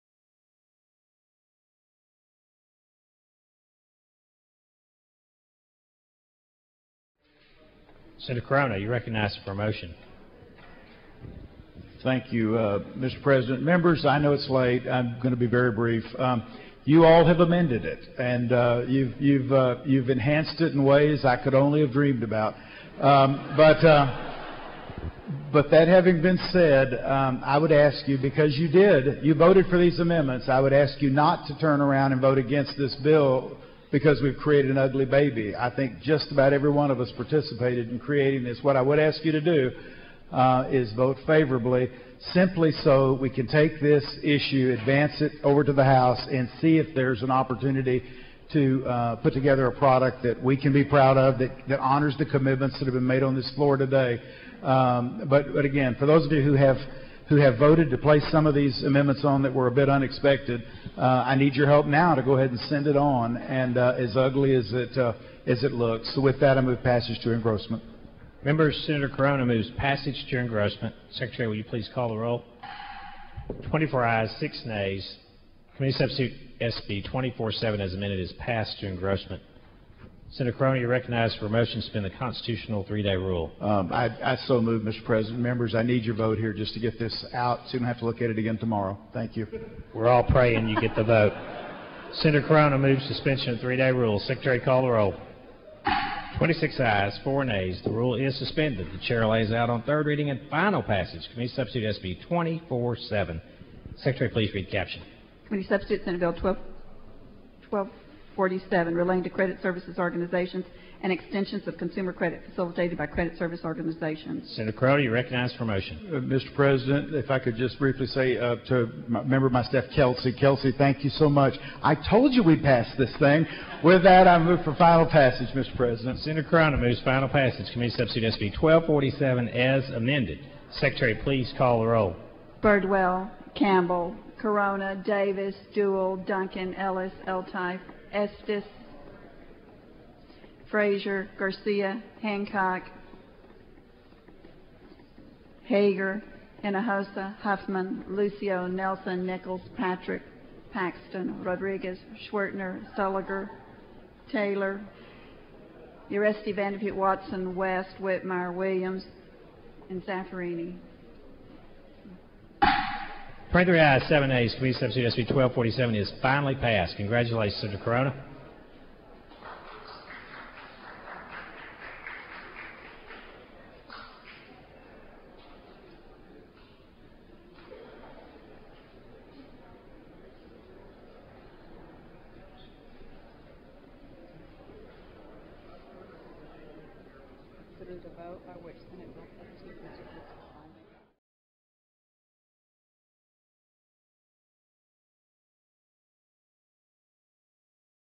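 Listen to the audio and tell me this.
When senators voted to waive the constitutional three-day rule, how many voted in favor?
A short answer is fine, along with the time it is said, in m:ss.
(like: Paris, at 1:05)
26, at 1:36.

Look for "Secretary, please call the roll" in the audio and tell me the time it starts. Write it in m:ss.
2:10.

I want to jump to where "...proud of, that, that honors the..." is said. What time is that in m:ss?
0:50.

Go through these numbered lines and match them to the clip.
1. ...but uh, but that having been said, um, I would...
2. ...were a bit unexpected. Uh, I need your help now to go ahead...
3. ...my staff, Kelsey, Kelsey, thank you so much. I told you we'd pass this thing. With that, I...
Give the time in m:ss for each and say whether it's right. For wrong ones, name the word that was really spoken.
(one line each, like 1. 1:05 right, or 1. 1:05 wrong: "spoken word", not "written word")
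1. 0:23 right
2. 0:59 right
3. 1:59 right.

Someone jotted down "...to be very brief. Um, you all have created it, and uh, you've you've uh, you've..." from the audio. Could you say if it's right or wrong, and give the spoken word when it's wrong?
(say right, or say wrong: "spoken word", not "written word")
wrong: "amended", not "created".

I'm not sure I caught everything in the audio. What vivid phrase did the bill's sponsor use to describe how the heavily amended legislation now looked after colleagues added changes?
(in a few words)
ugly baby.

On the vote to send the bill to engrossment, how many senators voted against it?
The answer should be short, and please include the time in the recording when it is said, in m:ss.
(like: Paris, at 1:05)
6, at 1:14.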